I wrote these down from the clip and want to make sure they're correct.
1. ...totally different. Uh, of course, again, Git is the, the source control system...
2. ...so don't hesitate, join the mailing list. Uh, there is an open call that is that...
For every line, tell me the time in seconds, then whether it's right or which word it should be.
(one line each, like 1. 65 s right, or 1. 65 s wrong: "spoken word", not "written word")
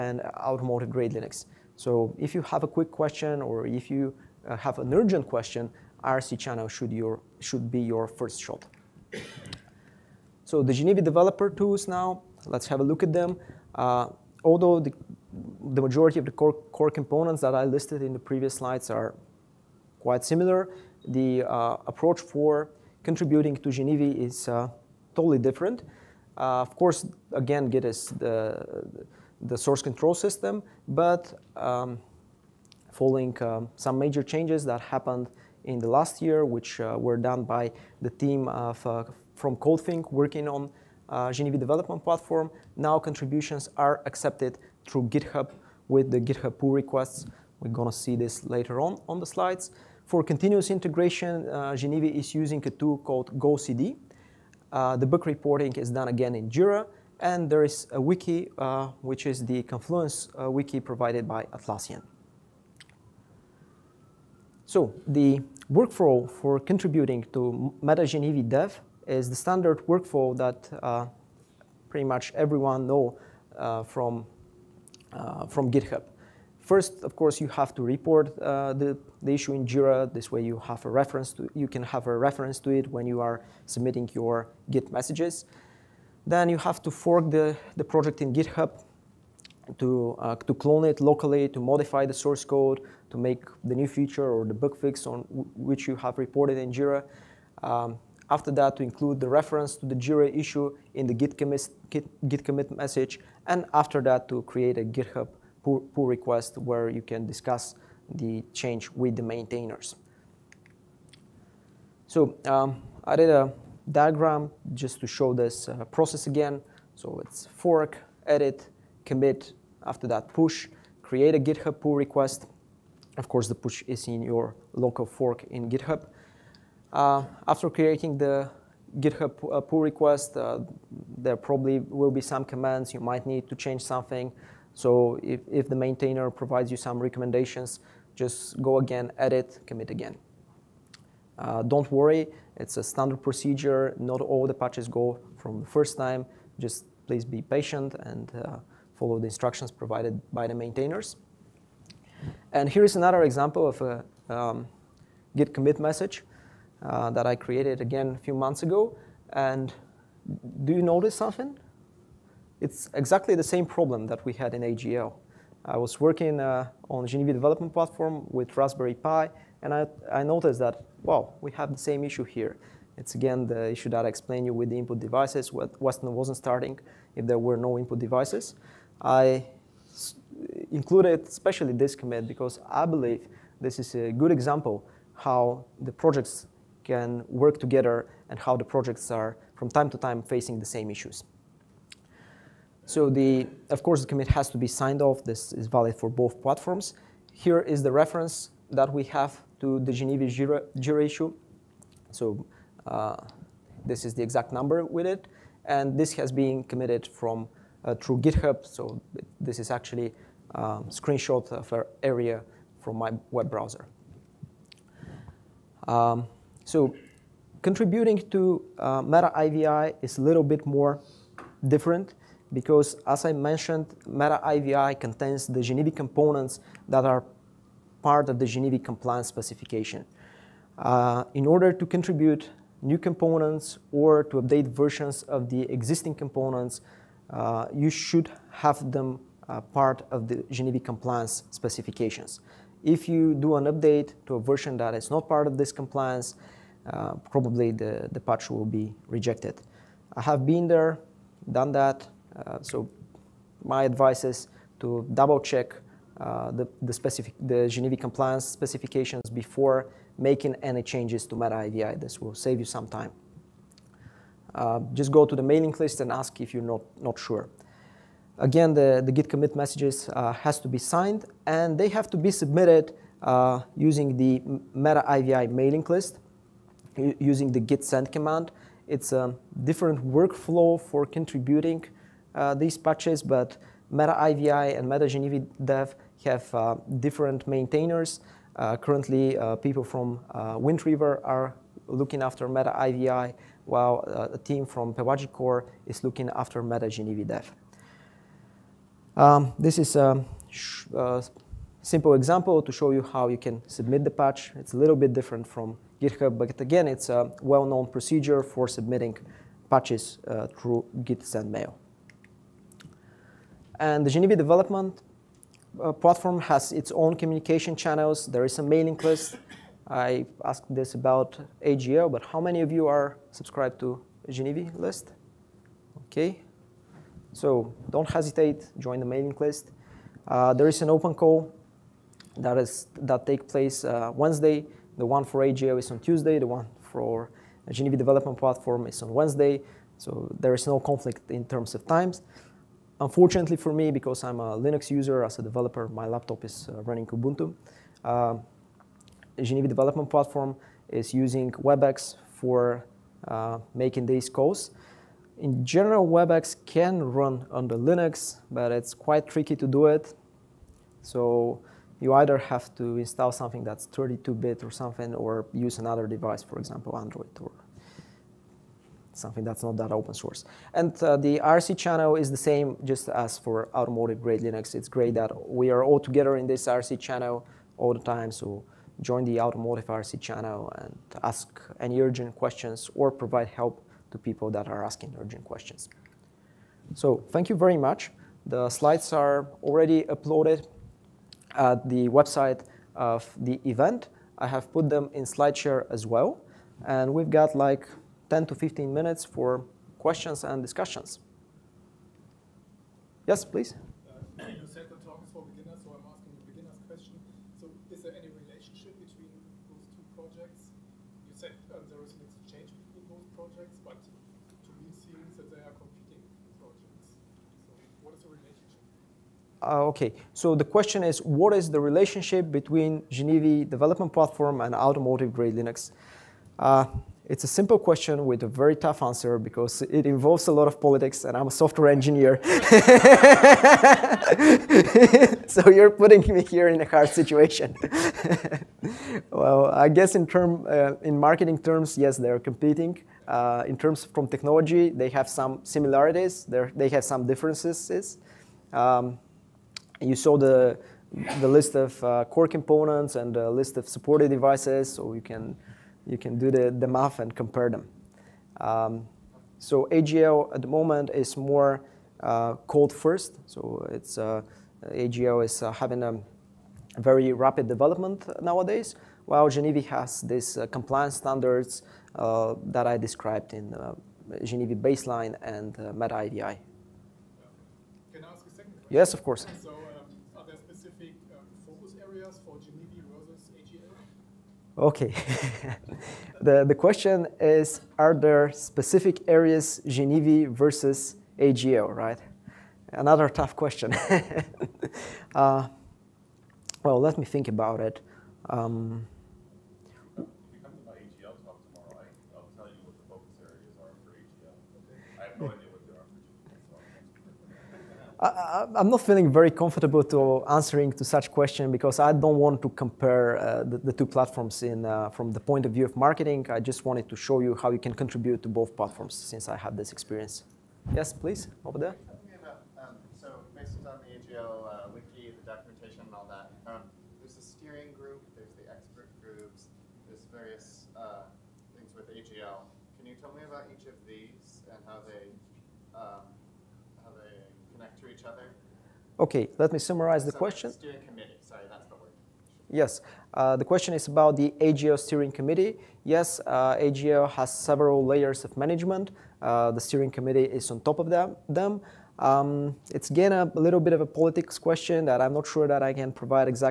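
1. 25 s right
2. 327 s right.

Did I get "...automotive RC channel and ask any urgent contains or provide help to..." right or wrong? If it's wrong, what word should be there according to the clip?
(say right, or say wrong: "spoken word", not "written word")
wrong: "questions", not "contains".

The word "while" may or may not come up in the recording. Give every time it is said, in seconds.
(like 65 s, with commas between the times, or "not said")
293 s, 469 s.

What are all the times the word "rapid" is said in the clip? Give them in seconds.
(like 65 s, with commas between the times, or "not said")
467 s.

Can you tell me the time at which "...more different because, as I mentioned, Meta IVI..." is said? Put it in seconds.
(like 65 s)
220 s.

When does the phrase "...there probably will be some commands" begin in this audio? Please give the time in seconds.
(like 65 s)
131 s.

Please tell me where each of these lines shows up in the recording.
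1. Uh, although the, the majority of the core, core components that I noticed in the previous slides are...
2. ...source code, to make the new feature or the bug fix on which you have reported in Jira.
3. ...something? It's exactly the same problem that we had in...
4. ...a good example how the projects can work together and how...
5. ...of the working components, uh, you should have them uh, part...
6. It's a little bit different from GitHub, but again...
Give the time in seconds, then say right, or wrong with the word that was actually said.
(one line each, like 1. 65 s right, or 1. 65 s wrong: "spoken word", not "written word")
1. 13 s wrong: "listed", not "noticed"
2. 92 s right
3. 161 s right
4. 183 s right
5. 235 s wrong: "existing", not "working"
6. 304 s right.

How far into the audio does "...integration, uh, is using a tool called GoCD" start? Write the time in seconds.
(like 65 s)
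50 s.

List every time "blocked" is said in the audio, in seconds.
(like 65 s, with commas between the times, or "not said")
not said.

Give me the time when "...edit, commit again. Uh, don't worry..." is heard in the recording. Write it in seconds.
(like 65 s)
139 s.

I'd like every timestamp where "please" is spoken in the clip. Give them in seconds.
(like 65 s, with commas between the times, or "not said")
147 s, 403 s, 521 s.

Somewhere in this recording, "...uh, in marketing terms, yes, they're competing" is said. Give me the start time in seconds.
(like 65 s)
440 s.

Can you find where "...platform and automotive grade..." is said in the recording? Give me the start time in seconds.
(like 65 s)
424 s.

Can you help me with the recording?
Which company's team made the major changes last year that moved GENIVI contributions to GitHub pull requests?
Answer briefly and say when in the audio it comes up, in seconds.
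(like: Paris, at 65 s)
CodeThink, at 39 s.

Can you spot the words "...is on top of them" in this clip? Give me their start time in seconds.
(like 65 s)
550 s.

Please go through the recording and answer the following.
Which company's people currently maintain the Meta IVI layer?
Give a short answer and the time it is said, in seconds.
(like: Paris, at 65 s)
Wind River, at 290 s.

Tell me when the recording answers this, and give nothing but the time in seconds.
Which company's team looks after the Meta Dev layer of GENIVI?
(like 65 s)
294 s.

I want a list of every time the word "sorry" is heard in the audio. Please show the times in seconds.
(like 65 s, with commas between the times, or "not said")
541 s.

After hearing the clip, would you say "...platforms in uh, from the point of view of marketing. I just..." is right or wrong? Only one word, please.
right.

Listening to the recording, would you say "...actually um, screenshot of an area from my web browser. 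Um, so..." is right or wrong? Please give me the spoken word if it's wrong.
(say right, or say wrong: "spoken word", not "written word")
right.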